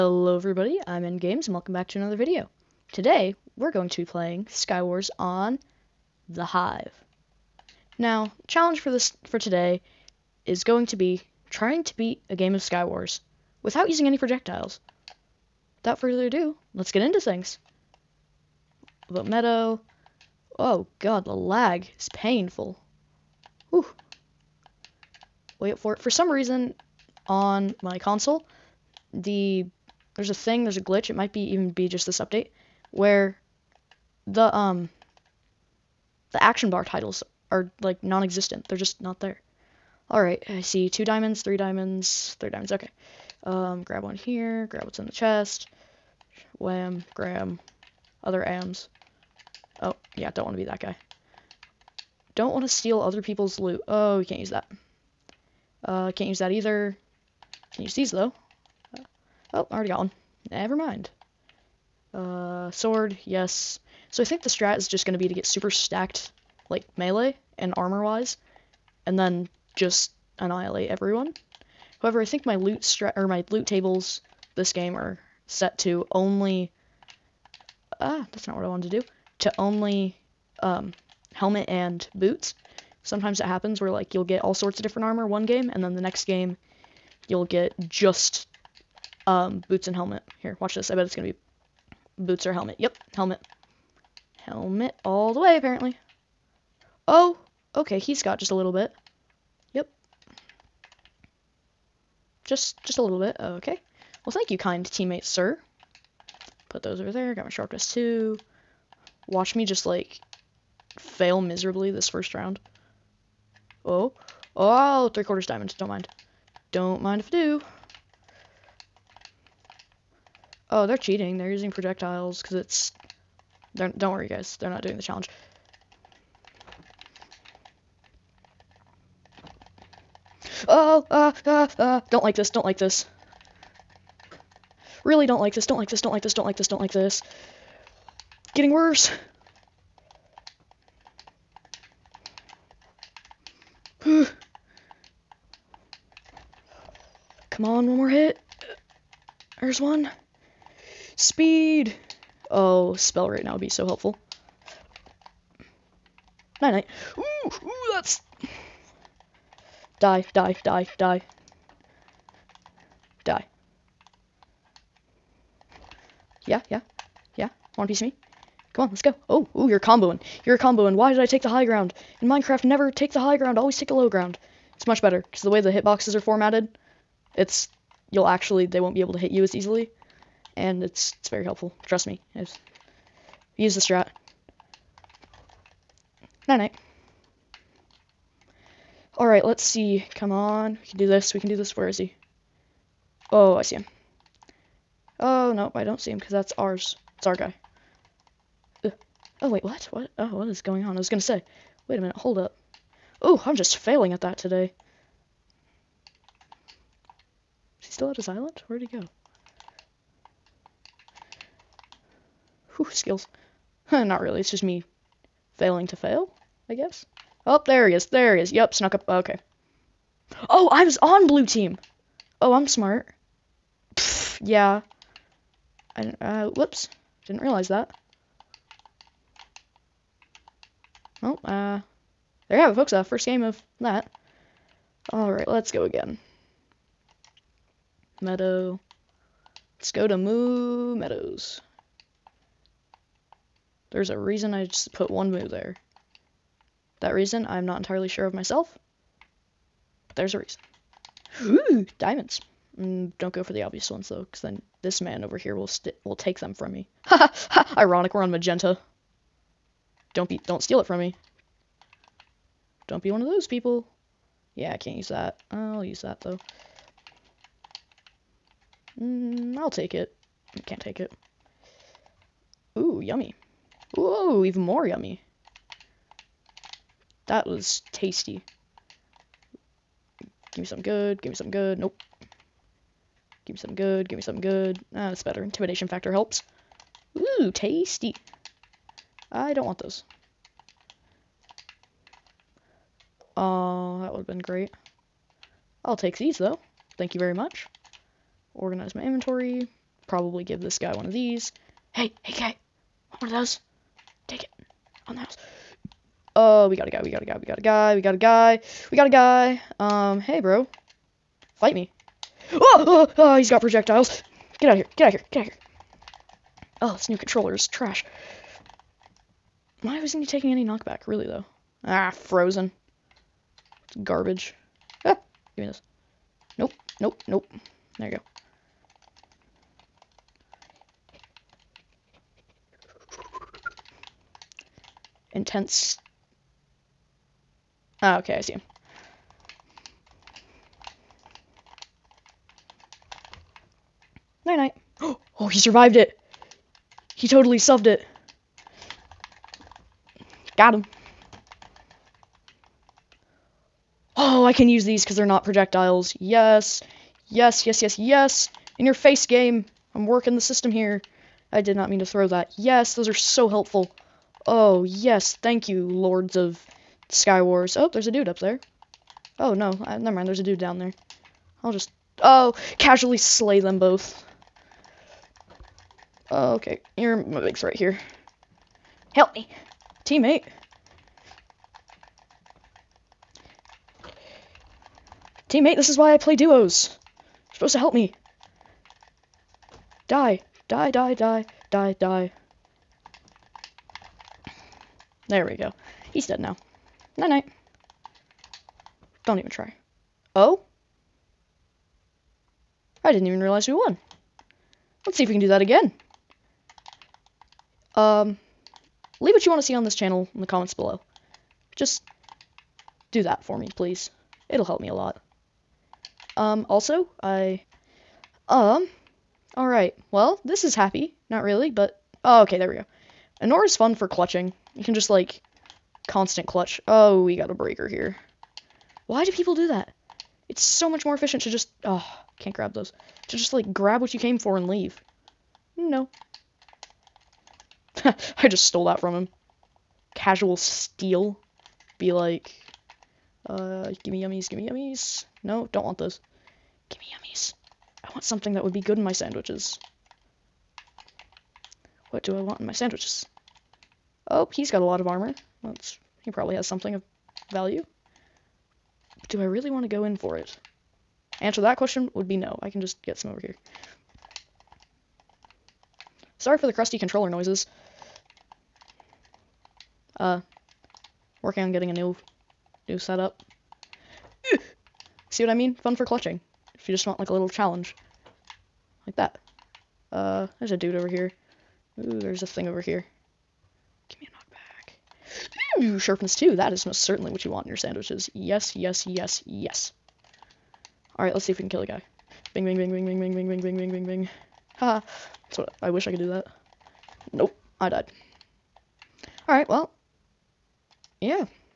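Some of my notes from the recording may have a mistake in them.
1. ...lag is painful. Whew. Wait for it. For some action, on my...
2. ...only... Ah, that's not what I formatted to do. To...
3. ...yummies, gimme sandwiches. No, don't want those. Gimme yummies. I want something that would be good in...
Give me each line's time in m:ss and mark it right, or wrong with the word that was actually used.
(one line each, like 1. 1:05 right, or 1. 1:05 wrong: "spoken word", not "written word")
1. 0:21 wrong: "reason", not "action"
2. 1:16 wrong: "wanted", not "formatted"
3. 7:24 wrong: "yummies", not "sandwiches".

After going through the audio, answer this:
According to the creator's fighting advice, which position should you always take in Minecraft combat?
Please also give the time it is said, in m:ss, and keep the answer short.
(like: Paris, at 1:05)
the low ground, at 2:53.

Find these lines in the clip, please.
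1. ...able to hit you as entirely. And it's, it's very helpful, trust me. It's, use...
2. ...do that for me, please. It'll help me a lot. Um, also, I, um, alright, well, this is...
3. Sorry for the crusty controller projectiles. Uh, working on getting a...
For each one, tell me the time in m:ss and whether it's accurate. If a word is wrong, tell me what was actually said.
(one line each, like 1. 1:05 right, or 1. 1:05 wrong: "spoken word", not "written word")
1. 2:59 wrong: "easily", not "entirely"
2. 6:53 right
3. 7:46 wrong: "noises", not "projectiles".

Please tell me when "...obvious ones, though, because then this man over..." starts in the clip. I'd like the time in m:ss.
4:13.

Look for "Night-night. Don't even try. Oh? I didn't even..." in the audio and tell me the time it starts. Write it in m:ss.
6:37.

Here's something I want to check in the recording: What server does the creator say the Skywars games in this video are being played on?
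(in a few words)
The Hive.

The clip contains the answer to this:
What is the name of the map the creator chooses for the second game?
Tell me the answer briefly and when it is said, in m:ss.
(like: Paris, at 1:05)
Moo Meadows, at 4:00.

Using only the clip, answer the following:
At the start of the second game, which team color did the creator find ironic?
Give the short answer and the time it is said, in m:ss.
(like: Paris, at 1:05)
magenta, at 4:18.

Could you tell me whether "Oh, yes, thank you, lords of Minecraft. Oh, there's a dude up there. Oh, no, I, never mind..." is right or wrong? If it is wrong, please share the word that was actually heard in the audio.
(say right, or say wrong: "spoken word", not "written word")
wrong: "Skywars", not "Minecraft".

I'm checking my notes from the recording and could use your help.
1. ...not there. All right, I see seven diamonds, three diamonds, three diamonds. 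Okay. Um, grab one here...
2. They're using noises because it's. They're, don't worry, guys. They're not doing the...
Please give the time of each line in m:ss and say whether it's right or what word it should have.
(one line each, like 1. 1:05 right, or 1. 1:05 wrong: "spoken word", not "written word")
1. 0:39 wrong: "two", not "seven"
2. 2:01 wrong: "projectiles", not "noises".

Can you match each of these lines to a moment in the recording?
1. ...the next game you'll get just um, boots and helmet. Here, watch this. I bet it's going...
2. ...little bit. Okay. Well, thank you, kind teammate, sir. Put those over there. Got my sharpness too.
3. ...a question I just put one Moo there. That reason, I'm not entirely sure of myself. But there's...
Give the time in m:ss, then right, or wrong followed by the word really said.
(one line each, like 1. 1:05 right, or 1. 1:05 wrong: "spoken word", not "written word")
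1. 1:25 right
2. 1:43 right
3. 4:04 wrong: "reason", not "question".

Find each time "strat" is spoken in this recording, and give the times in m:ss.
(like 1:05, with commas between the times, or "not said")
1:04, 1:12, 3:03.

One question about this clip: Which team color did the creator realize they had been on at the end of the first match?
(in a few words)
blue.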